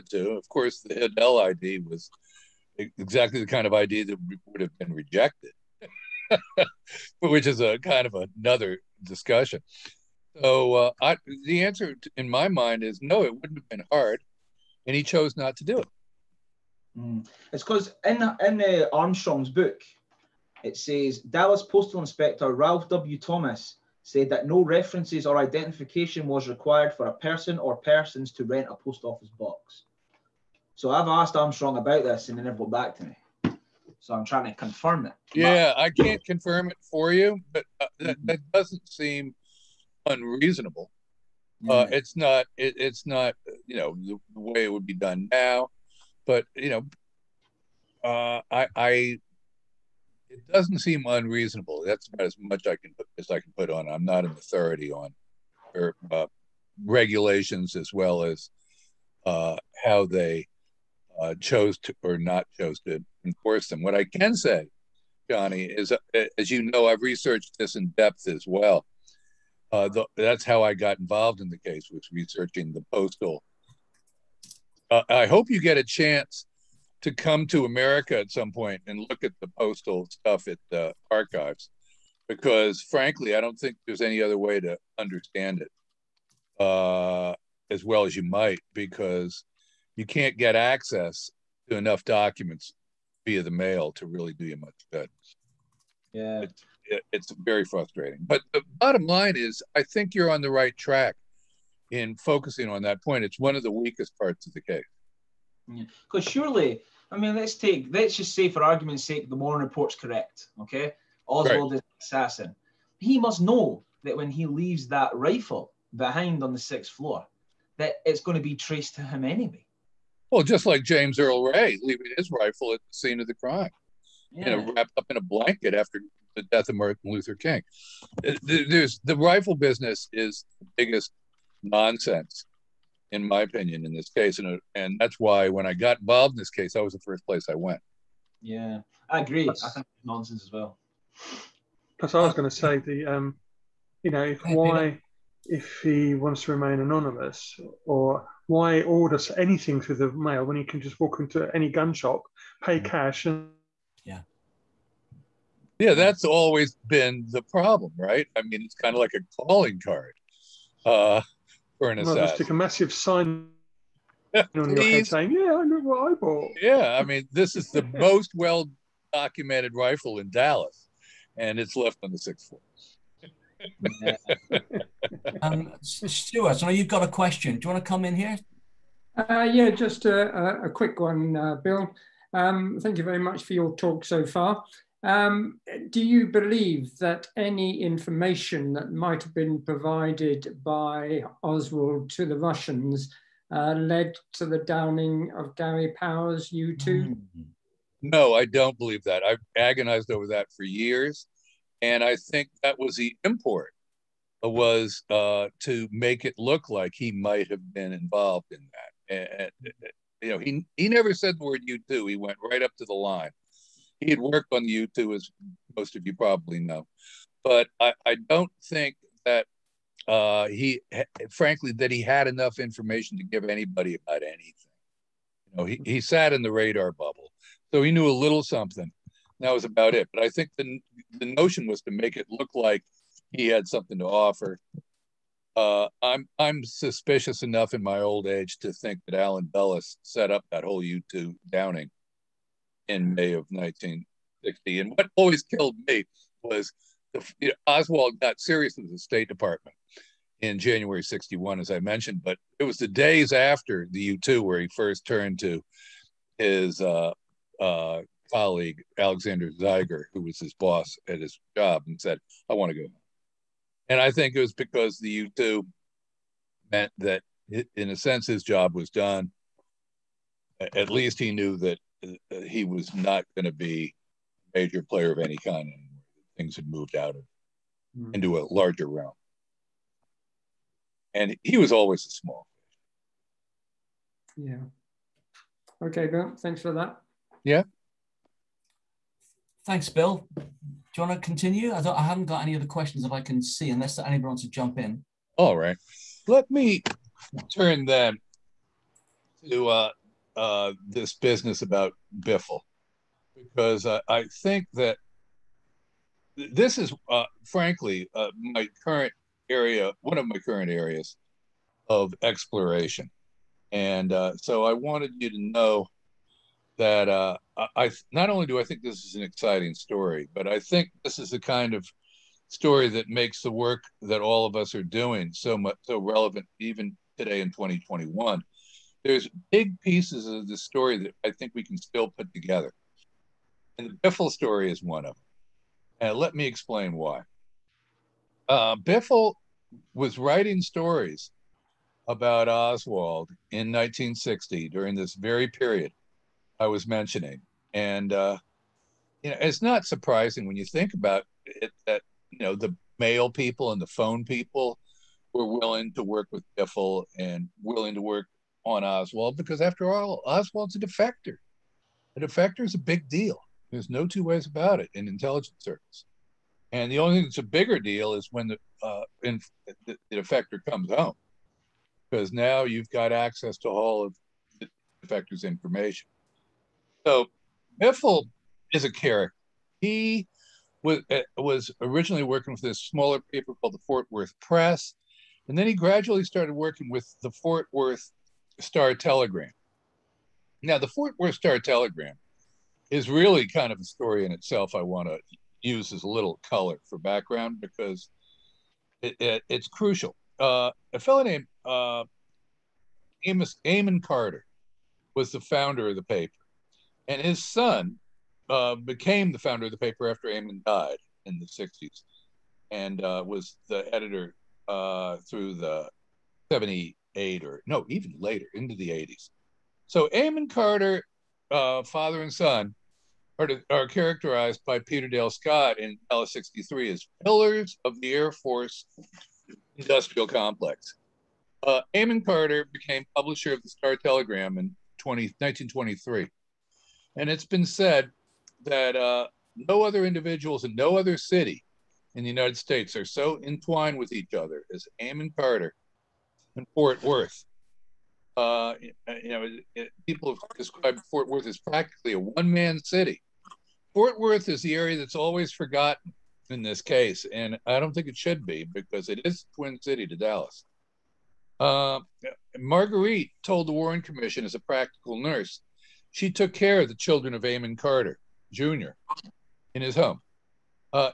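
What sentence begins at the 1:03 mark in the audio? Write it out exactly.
What I can say, Johnny, is uh, as you know, I've researched this in depth as well.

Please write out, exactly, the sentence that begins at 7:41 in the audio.
Uh, Marguerite told the Warren Commission as a practical nurse she took care of the children of Amon Carter Jr.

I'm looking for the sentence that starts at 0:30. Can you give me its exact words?
So I've asked Armstrong about this, and he never got back to me.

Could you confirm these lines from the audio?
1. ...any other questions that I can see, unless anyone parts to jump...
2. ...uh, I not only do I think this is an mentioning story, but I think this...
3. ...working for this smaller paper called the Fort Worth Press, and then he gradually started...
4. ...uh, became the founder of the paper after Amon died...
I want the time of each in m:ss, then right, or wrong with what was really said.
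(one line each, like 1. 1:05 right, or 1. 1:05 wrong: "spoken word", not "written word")
1. 4:52 wrong: "wants", not "parts"
2. 5:17 wrong: "exciting", not "mentioning"
3. 6:22 right
4. 6:48 right.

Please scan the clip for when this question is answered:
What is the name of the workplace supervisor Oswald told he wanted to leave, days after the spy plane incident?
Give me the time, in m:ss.
4:18.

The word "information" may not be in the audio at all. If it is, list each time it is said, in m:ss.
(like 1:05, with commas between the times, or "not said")
3:07, 3:42, 6:15.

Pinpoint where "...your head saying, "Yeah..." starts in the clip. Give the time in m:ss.
2:44.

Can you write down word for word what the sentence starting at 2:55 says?
um, Stuart, I know you've got a question.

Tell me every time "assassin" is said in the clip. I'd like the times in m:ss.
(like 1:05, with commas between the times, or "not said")
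1:52, 2:41.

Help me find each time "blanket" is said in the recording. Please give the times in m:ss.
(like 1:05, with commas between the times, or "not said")
2:05.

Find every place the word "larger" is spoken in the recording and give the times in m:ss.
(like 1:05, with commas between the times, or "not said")
4:38.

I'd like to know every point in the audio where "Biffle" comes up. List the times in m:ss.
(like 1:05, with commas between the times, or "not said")
5:02, 5:34, 5:38, 5:56, 6:17.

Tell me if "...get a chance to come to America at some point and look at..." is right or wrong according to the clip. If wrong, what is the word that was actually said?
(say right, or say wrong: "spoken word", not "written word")
right.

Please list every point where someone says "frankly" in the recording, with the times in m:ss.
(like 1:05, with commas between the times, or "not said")
1:22, 3:41, 5:07.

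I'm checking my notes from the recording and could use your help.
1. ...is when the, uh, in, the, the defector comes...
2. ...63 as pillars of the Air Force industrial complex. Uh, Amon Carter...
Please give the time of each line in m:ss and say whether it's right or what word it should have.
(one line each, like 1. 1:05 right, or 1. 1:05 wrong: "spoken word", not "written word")
1. 6:08 right
2. 7:06 right.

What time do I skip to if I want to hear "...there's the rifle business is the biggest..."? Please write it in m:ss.
2:08.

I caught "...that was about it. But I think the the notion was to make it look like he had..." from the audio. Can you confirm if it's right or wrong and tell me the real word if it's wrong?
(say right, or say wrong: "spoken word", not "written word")
right.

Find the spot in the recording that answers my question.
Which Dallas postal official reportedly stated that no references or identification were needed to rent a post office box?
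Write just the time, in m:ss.
0:22.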